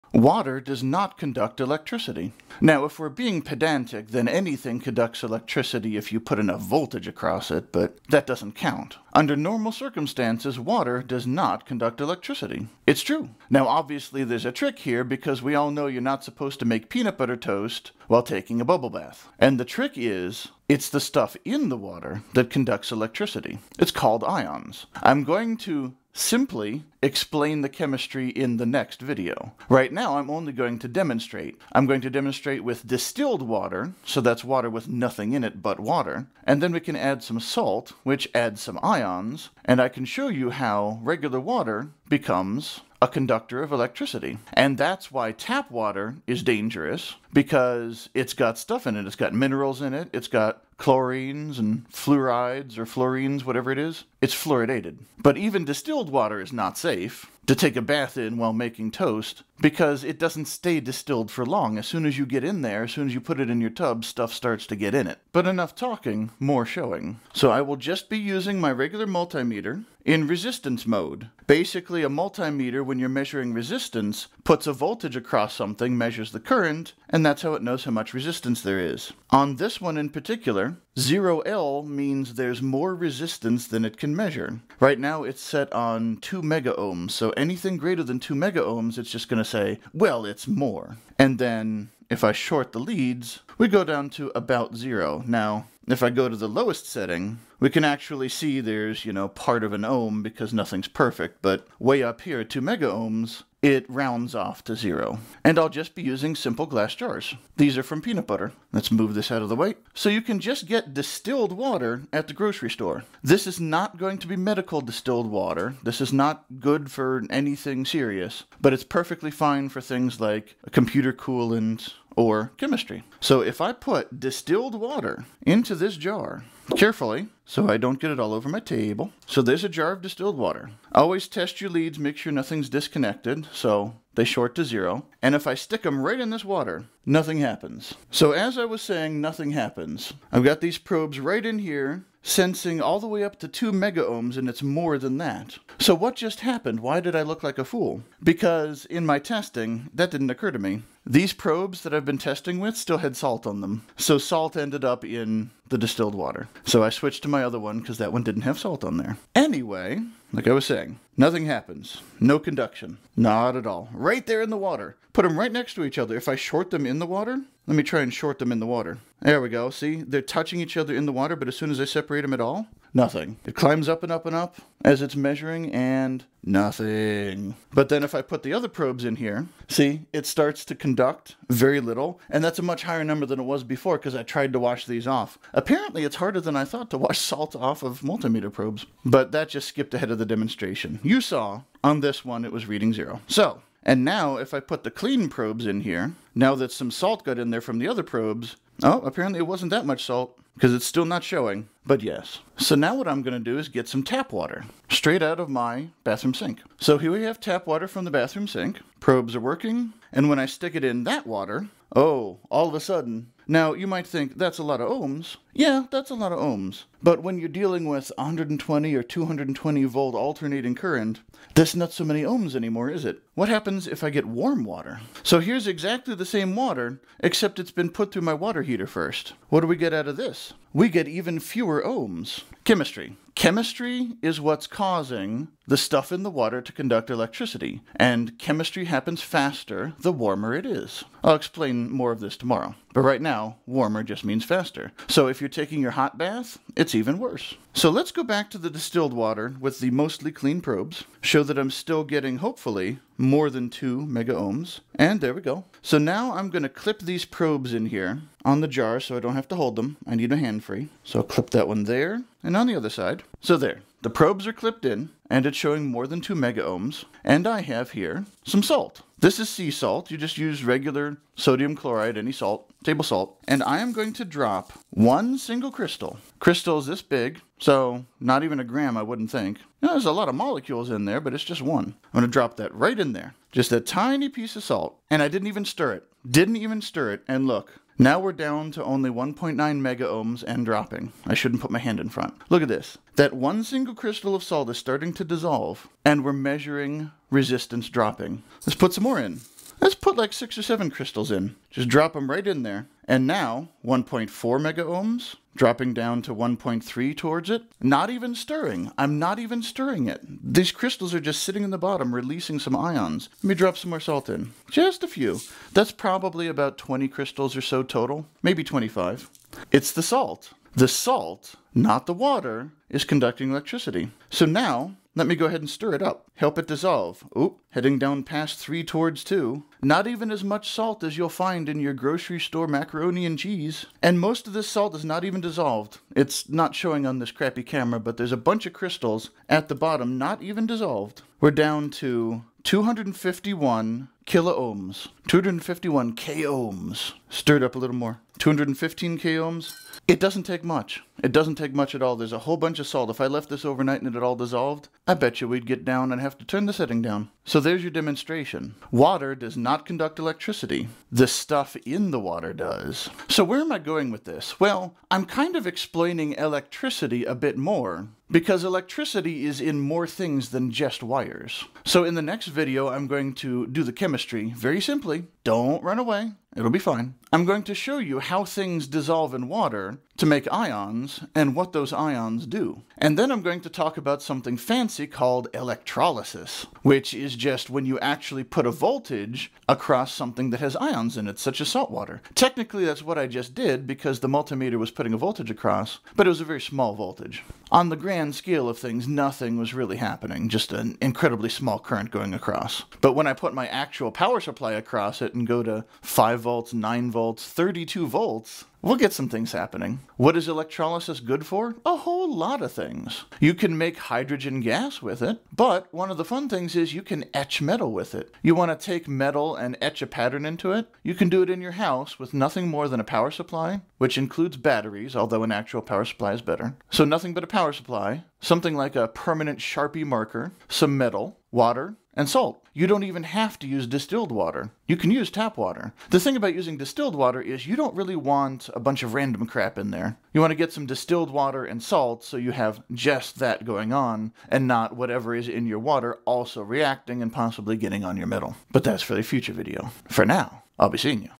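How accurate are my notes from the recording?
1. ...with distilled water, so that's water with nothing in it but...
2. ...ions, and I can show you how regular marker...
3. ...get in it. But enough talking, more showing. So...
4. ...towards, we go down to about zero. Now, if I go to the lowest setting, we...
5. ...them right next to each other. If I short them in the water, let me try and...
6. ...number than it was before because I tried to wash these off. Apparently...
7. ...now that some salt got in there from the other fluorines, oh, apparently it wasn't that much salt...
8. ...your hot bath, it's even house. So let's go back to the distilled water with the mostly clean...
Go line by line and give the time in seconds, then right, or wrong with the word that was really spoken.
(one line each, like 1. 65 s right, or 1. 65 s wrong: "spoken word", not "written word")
1. 32 s right
2. 38 s wrong: "water", not "marker"
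3. 64 s right
4. 92 s wrong: "leads", not "towards"
5. 165 s right
6. 183 s right
7. 196 s wrong: "probes", not "fluorines"
8. 245 s wrong: "worse", not "house".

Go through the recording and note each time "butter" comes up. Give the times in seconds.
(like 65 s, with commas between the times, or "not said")
17 s, 108 s.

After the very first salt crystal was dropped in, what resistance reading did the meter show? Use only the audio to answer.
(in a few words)
1.9 megaohms.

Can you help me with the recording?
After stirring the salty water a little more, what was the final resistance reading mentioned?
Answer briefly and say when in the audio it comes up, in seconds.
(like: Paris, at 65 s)
215 kilohms, at 348 s.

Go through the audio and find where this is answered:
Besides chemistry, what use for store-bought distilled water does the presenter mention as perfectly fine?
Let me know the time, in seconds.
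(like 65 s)
120 s.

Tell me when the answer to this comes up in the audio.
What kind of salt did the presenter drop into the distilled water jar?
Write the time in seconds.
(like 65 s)
269 s.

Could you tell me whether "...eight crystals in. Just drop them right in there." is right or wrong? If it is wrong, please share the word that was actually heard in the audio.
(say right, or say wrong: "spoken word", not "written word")
wrong: "seven", not "eight".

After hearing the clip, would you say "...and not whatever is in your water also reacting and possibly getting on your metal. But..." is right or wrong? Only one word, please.
right.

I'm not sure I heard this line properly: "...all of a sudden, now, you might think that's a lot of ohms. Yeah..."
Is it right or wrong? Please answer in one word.
right.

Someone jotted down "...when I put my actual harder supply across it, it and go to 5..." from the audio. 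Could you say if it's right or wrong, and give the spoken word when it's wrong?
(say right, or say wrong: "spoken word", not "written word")
wrong: "power", not "harder".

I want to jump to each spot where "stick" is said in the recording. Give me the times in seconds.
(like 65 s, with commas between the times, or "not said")
135 s, 210 s.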